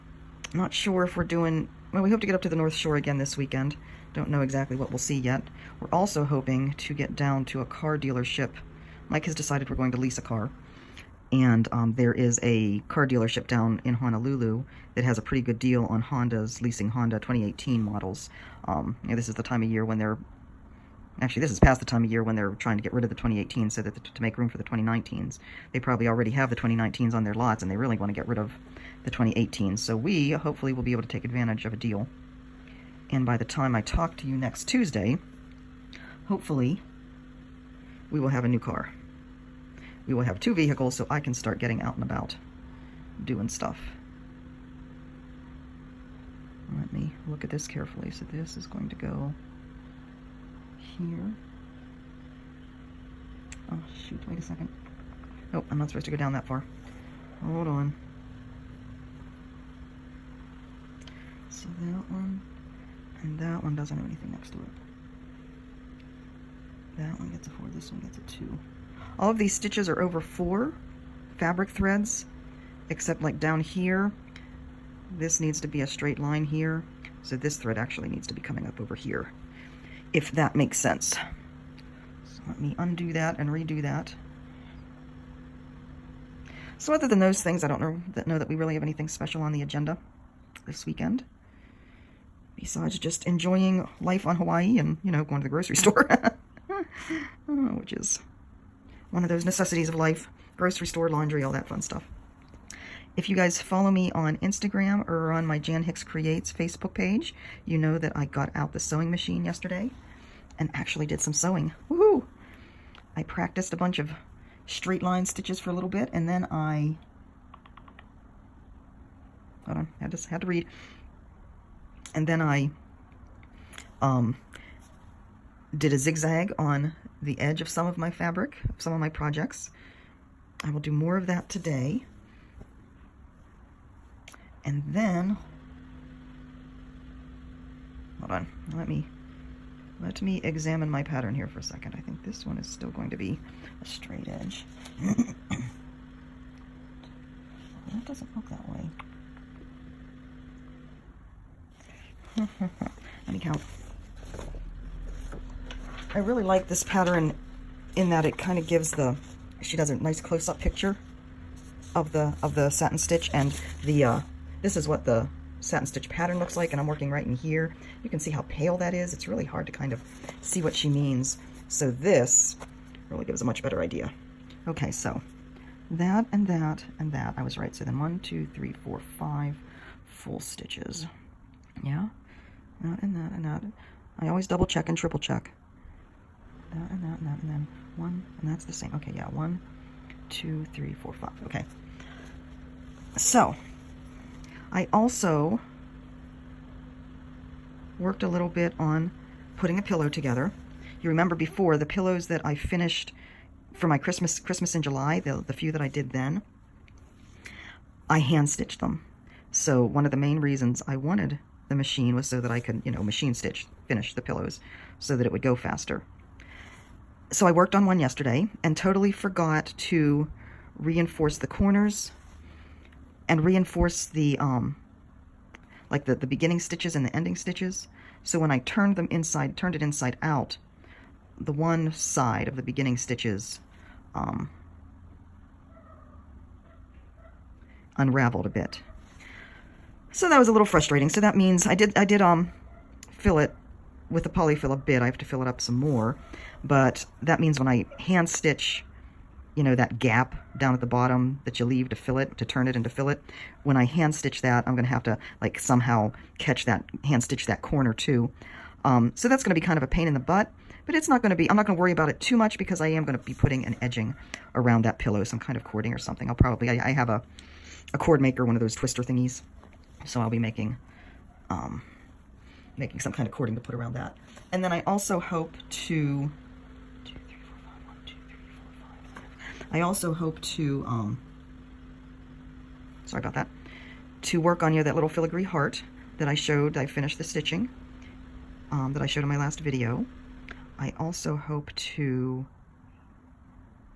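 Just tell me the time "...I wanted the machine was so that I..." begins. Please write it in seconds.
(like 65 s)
210 s.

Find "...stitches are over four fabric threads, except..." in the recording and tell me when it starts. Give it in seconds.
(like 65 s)
69 s.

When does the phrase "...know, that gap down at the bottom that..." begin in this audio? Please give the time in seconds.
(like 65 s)
249 s.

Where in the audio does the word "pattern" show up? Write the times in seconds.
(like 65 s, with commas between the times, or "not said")
141 s, 156 s, 166 s.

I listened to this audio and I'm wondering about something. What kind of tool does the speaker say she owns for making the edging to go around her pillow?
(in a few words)
cord maker.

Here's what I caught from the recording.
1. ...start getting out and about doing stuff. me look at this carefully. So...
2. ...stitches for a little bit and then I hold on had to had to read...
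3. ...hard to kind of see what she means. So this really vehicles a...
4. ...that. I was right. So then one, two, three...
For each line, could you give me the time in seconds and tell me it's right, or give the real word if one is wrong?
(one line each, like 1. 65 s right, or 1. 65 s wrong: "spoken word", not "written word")
1. 41 s right
2. 115 s right
3. 169 s wrong: "gives", not "vehicles"
4. 177 s right.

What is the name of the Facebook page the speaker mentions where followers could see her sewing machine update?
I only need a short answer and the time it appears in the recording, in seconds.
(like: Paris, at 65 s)
Jan Hicks Creates, at 105 s.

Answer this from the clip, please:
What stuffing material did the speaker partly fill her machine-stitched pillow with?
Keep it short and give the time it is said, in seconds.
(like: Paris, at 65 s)
polyfill, at 244 s.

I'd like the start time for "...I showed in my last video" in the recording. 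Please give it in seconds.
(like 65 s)
289 s.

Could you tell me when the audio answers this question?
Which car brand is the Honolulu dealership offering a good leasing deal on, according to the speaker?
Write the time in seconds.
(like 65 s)
16 s.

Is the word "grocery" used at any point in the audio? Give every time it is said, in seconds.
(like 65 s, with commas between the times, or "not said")
95 s, 100 s.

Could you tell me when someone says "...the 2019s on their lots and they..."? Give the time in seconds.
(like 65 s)
26 s.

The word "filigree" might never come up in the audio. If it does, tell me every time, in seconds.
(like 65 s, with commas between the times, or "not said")
285 s.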